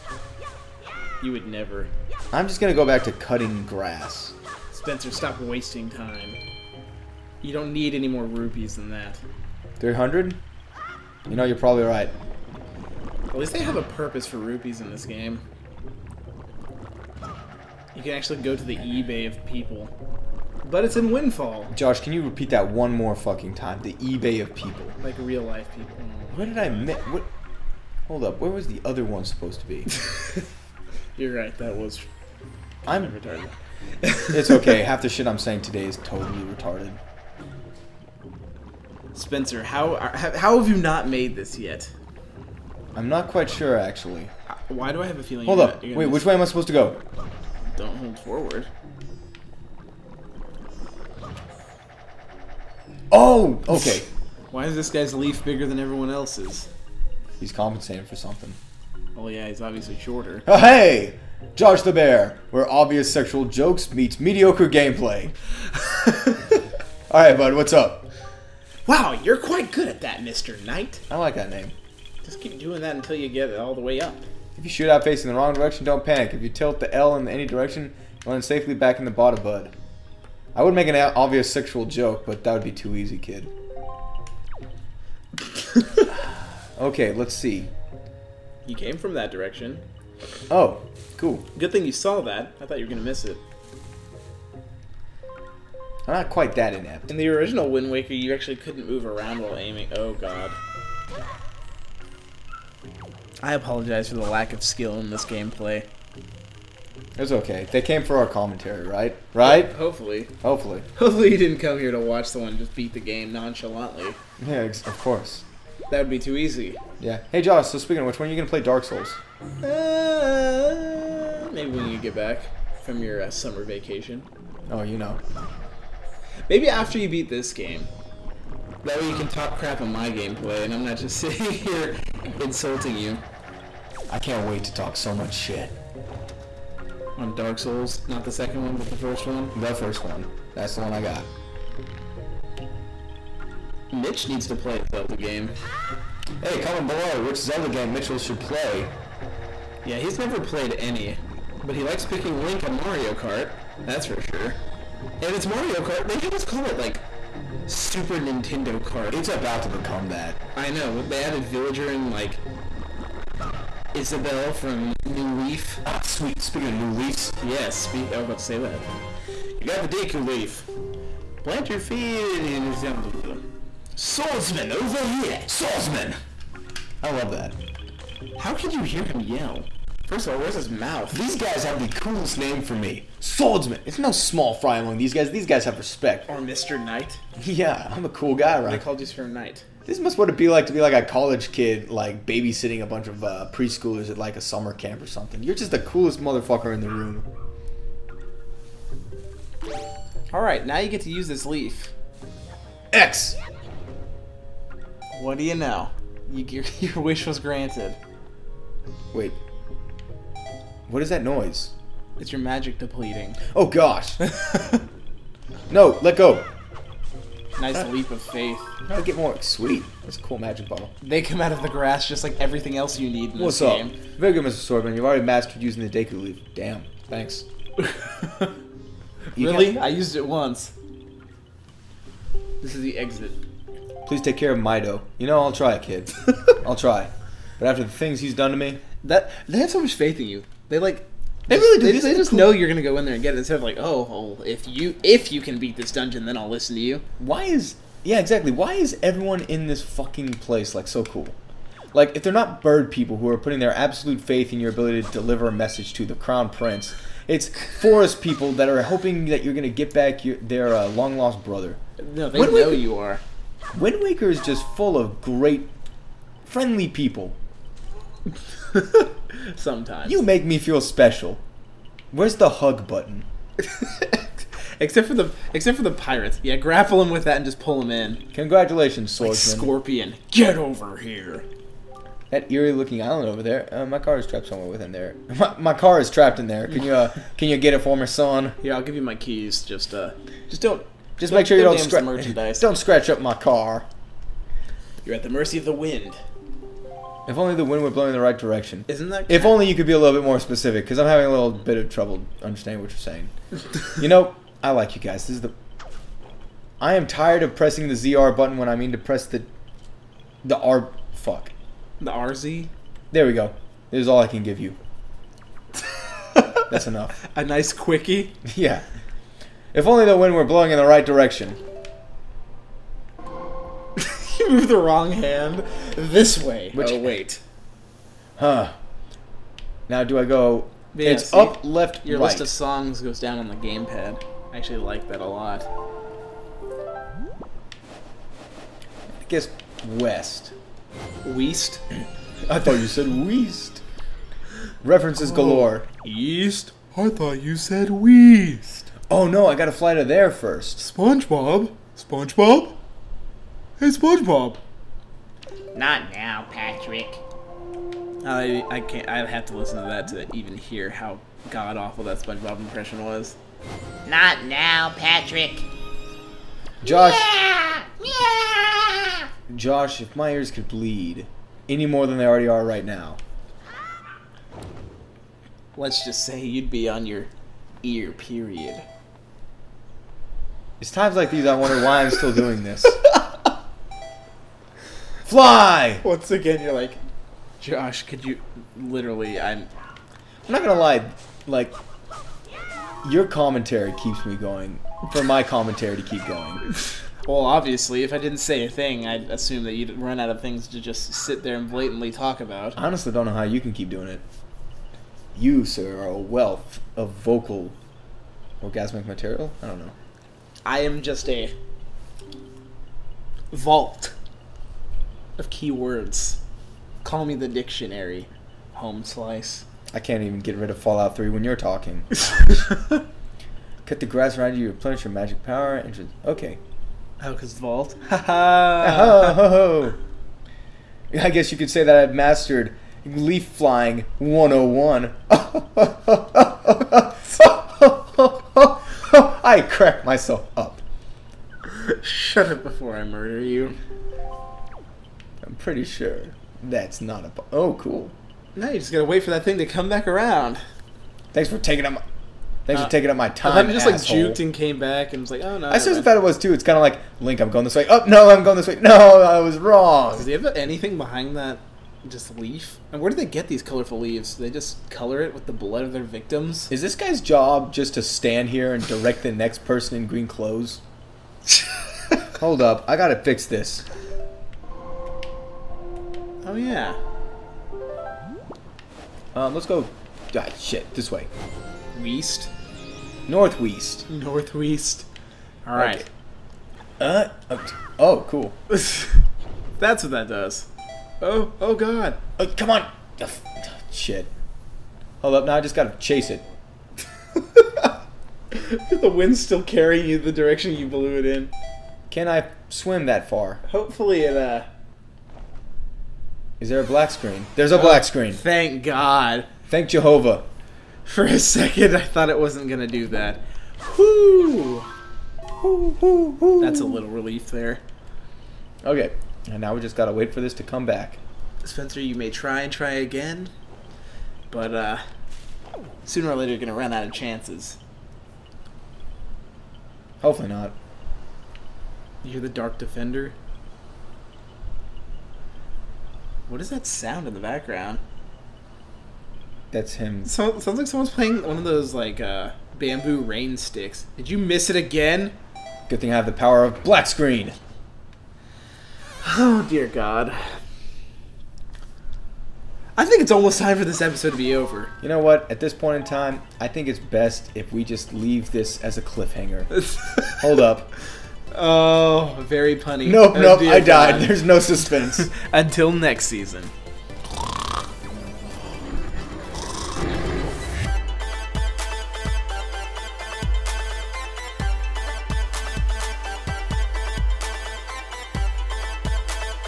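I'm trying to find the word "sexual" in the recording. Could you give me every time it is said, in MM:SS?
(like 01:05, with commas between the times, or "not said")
01:03, 01:21.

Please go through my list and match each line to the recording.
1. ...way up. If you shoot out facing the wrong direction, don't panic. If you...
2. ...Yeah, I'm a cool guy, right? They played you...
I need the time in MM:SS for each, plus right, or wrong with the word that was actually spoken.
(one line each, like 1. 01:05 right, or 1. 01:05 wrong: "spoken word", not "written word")
1. 01:13 right
2. 03:07 wrong: "called", not "played".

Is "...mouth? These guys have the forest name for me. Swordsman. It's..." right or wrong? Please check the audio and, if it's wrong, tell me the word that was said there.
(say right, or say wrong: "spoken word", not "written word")
wrong: "coolest", not "forest".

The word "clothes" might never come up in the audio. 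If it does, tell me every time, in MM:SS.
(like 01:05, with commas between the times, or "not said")
07:50.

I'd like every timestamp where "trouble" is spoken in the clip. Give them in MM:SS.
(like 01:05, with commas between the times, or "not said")
05:01.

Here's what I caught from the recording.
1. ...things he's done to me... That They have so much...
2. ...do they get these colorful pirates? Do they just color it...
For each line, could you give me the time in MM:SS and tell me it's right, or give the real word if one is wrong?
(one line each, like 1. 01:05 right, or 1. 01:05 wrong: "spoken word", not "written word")
1. 03:57 right
2. 07:43 wrong: "leaves", not "pirates".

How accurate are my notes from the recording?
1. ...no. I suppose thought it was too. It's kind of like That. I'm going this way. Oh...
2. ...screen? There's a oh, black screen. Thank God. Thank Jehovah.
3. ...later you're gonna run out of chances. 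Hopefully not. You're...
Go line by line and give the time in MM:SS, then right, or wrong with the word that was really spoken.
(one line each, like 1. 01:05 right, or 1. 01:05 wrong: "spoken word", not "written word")
1. 07:35 wrong: "Link", not "That"
2. 08:27 right
3. 08:46 right.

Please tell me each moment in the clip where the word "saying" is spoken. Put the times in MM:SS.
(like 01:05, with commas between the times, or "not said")
00:35, 05:02.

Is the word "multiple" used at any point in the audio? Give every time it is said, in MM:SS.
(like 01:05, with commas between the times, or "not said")
not said.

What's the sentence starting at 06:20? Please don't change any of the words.
It's times like these I wonder why I'm still doing this.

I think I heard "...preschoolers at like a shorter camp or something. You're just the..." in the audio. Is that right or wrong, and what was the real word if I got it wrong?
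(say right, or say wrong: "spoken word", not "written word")
wrong: "summer", not "shorter".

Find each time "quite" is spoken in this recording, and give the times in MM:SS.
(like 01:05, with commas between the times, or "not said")
00:43, 01:09, 01:36.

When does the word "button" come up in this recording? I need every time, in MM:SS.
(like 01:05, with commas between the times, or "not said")
04:32, 05:08.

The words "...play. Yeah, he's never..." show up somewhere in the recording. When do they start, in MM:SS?
02:28.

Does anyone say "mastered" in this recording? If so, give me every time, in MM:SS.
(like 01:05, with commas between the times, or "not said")
03:45, 07:12.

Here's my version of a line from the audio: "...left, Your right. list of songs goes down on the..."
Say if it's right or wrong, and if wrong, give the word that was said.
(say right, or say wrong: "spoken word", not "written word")
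right.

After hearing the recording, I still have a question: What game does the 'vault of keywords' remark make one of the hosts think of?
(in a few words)
Fallout 3.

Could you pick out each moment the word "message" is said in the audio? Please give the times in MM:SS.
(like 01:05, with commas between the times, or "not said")
04:15.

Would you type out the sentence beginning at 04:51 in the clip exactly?
Just don't, make sure you don't, don't scratch merchandise.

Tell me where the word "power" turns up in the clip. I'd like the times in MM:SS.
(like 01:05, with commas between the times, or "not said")
07:05, 09:06.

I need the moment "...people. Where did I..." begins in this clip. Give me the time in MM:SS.
00:25.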